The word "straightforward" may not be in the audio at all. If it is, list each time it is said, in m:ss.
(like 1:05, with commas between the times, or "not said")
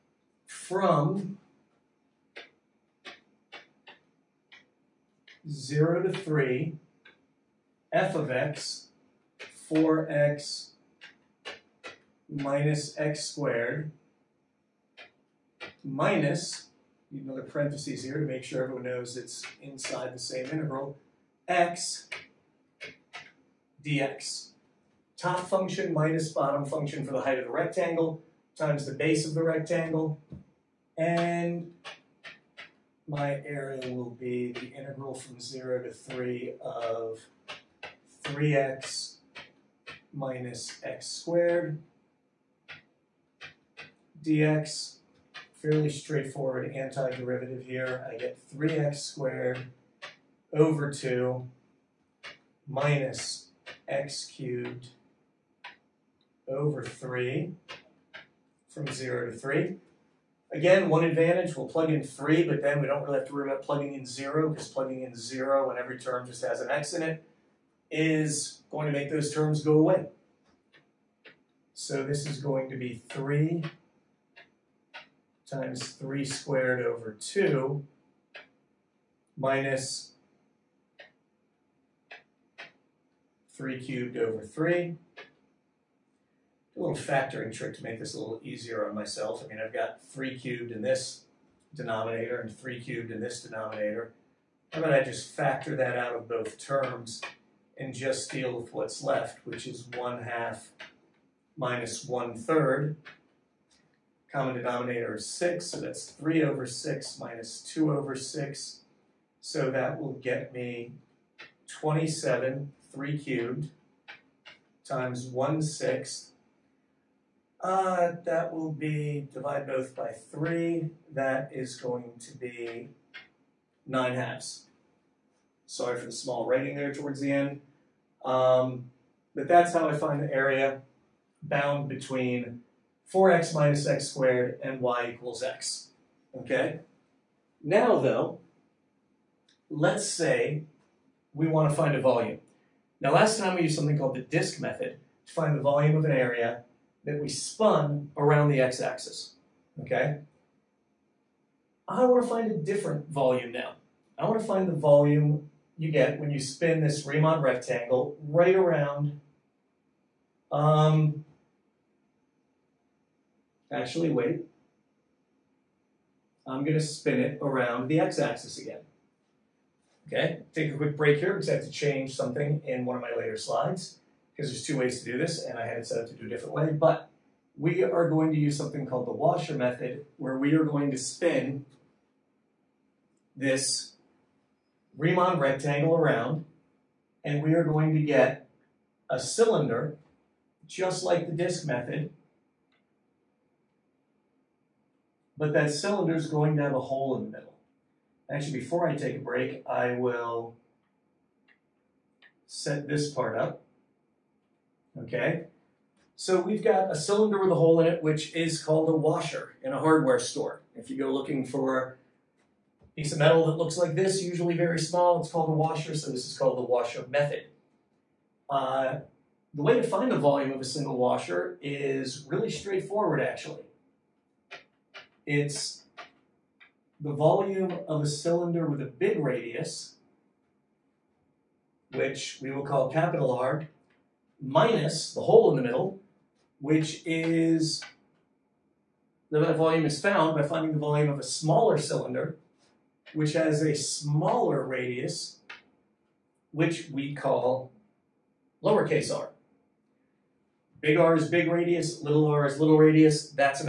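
0:45, 3:42.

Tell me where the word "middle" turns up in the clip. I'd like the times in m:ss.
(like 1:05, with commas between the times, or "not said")
3:17, 3:55.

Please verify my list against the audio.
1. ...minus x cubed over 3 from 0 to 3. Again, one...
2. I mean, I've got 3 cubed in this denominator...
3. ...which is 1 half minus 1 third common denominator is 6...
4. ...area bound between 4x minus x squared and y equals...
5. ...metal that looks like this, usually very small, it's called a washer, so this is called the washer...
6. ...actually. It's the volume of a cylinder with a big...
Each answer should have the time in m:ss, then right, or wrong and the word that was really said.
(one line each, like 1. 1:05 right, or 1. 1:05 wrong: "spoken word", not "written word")
1. 0:52 right
2. 1:29 right
3. 1:39 right
4. 2:10 right
5. 3:33 right
6. 3:43 right.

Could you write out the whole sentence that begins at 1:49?
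So that will get me 27, 3 cubed, times 1 sixth.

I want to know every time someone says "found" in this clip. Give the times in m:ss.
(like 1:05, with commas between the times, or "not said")
4:00.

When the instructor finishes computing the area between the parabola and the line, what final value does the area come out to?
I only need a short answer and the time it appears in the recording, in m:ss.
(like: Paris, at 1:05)
9/2, at 2:03.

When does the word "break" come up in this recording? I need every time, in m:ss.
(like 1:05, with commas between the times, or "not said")
2:50, 3:19.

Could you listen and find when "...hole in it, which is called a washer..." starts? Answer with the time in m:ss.
3:27.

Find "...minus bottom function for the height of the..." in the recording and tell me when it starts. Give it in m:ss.
0:25.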